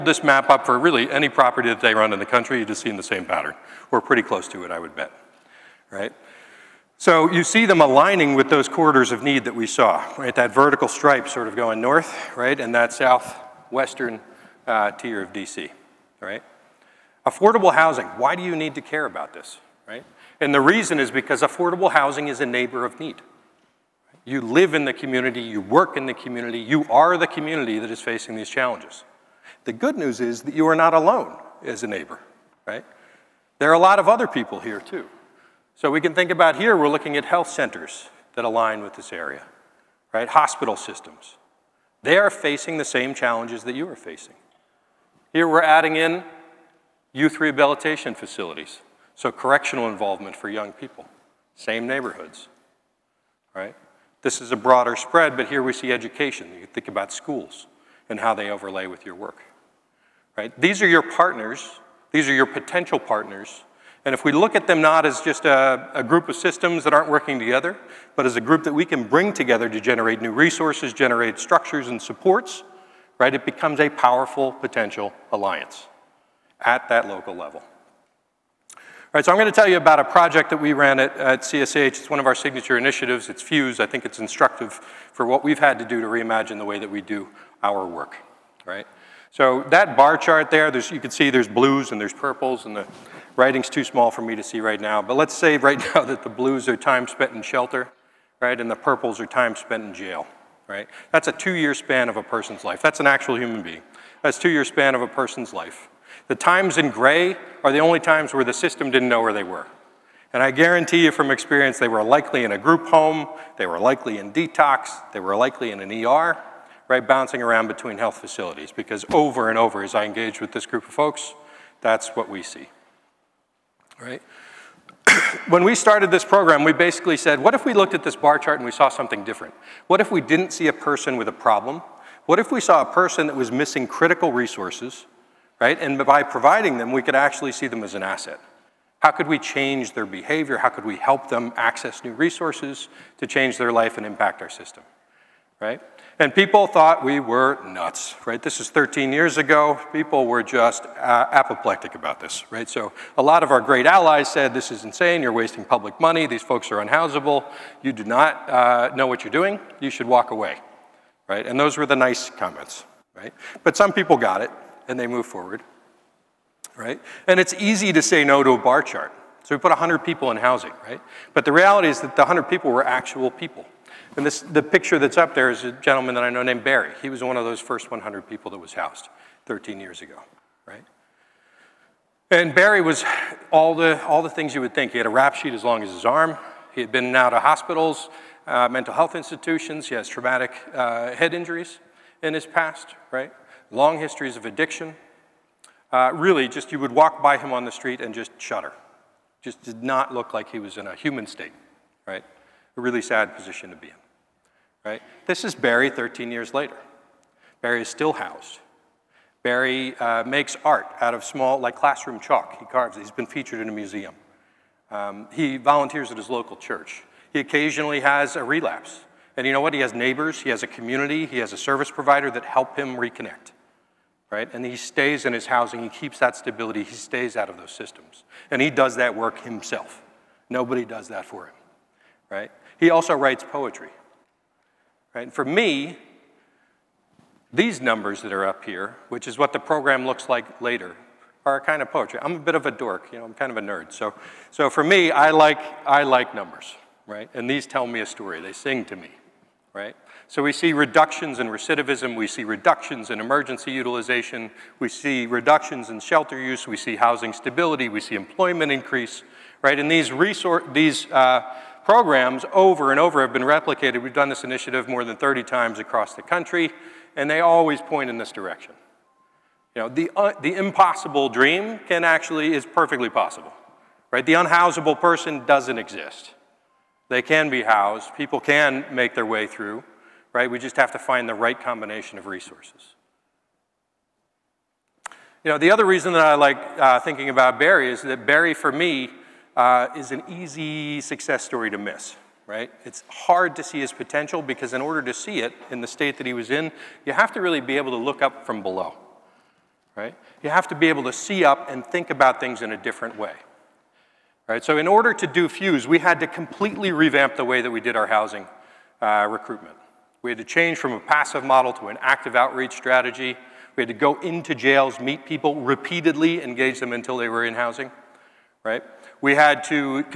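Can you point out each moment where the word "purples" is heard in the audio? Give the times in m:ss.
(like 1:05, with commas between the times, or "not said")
1:32, 1:38.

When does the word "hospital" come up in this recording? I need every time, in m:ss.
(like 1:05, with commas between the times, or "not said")
0:40, 3:07.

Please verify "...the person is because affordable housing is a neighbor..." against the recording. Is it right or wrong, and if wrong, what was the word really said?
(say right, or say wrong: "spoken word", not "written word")
wrong: "reason", not "person".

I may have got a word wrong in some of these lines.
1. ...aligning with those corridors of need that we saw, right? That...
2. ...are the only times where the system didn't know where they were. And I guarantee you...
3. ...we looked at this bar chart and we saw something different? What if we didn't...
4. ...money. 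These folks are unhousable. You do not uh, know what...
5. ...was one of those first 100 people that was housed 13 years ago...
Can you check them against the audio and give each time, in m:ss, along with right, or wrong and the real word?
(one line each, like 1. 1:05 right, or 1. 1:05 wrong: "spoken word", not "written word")
1. 0:07 right
2. 1:47 right
3. 2:07 right
4. 2:35 right
5. 2:57 right.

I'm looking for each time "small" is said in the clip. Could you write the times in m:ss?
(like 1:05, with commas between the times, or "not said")
1:33, 3:31.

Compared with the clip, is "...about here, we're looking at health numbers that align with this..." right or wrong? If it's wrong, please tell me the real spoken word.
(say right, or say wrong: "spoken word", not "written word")
wrong: "centers", not "numbers".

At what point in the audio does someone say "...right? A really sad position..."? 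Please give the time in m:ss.
3:22.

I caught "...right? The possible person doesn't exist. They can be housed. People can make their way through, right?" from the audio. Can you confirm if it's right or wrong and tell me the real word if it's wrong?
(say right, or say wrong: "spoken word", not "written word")
wrong: "unhousable", not "possible".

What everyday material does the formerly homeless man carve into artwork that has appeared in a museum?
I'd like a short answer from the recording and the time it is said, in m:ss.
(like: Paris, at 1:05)
classroom chalk, at 3:31.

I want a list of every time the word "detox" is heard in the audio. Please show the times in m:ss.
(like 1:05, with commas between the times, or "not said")
1:54.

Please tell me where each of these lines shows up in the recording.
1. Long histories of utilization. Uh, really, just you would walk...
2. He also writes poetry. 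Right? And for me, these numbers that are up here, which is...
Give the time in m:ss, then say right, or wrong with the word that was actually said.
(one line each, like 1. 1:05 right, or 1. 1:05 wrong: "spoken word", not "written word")
1. 3:13 wrong: "addiction", not "utilization"
2. 3:52 right.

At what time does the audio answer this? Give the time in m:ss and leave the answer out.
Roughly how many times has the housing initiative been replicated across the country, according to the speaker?
4:24.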